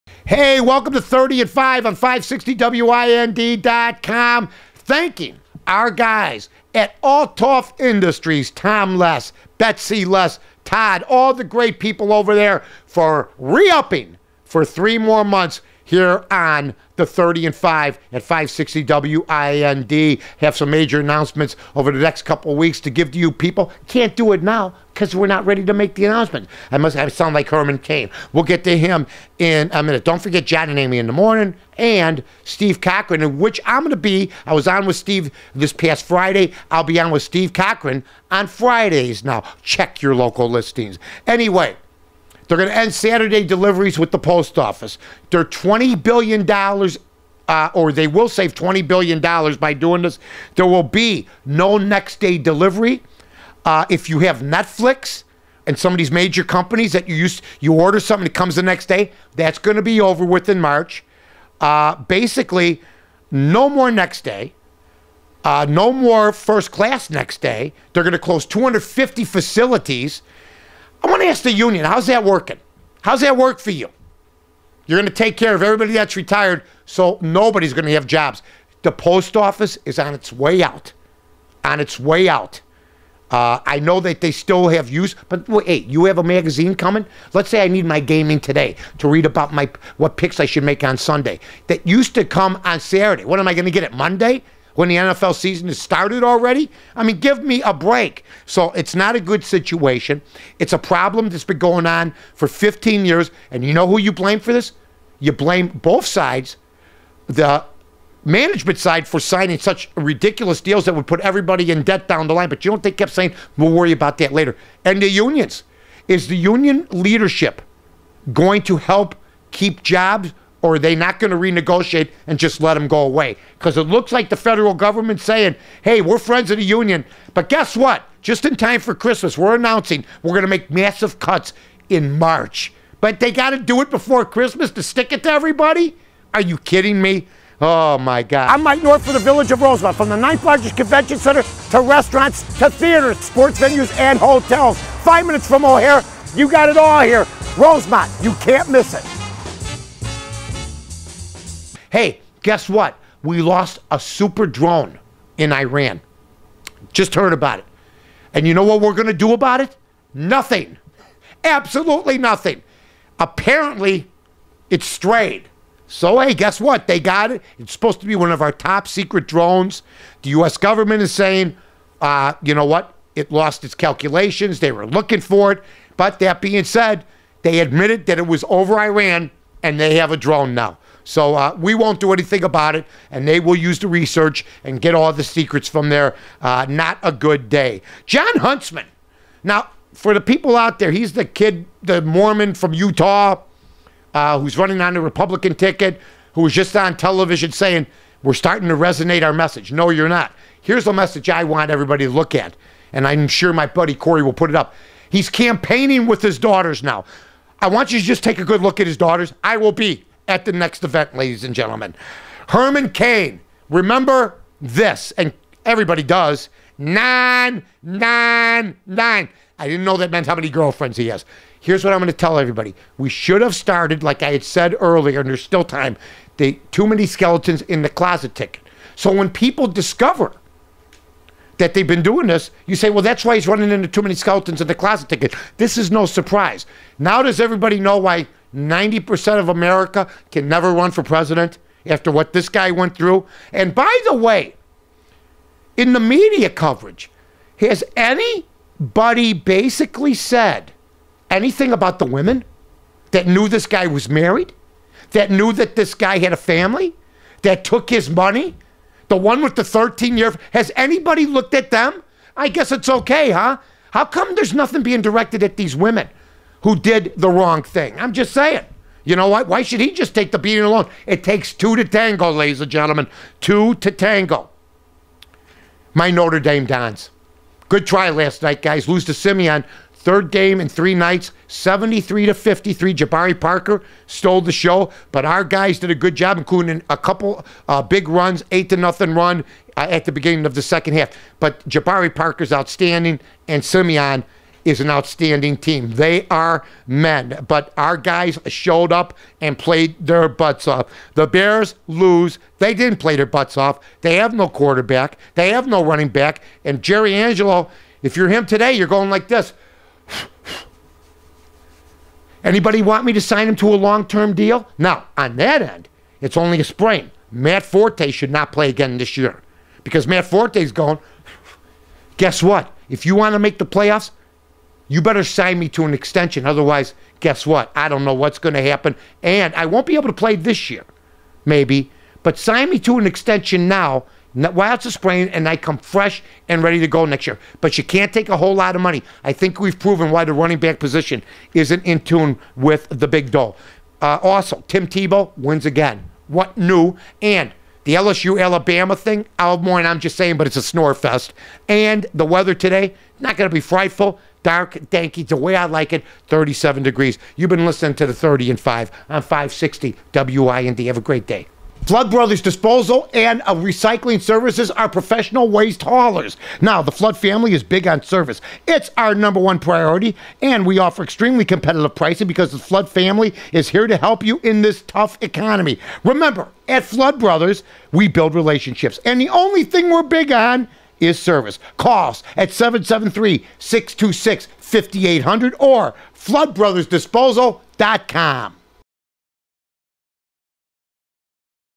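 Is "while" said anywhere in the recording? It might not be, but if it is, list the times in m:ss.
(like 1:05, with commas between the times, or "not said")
5:34.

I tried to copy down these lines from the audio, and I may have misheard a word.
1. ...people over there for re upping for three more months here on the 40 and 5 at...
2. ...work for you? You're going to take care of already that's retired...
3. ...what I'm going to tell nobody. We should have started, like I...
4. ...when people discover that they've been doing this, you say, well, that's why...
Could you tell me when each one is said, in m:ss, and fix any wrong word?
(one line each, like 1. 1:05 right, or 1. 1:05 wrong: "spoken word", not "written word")
1. 0:11 wrong: "30", not "40"
2. 1:13 wrong: "everybody", not "already"
3. 3:41 wrong: "everybody", not "nobody"
4. 3:49 right.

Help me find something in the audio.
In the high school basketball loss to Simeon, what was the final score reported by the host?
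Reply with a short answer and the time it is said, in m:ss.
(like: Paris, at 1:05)
73 to 53, at 4:41.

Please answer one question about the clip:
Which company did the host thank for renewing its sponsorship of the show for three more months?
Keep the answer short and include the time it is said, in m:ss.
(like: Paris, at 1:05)
Althoff Industries, at 0:07.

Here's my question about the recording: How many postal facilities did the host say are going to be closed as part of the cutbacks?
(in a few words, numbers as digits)
250.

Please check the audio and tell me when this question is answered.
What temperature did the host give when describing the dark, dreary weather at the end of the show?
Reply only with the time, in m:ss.
5:56.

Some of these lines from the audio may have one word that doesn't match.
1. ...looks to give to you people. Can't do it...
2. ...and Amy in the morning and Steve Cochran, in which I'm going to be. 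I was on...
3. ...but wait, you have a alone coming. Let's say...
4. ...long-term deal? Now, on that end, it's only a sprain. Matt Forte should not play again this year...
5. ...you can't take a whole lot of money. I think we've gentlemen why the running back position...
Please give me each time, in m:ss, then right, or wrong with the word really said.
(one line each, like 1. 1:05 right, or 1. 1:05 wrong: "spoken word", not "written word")
1. 0:22 wrong: "weeks", not "looks"
2. 0:30 right
3. 1:25 wrong: "magazine", not "alone"
4. 5:13 right
5. 5:37 wrong: "proven", not "gentlemen".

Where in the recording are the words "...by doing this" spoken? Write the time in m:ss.
0:49.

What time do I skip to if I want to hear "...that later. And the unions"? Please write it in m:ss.
1:54.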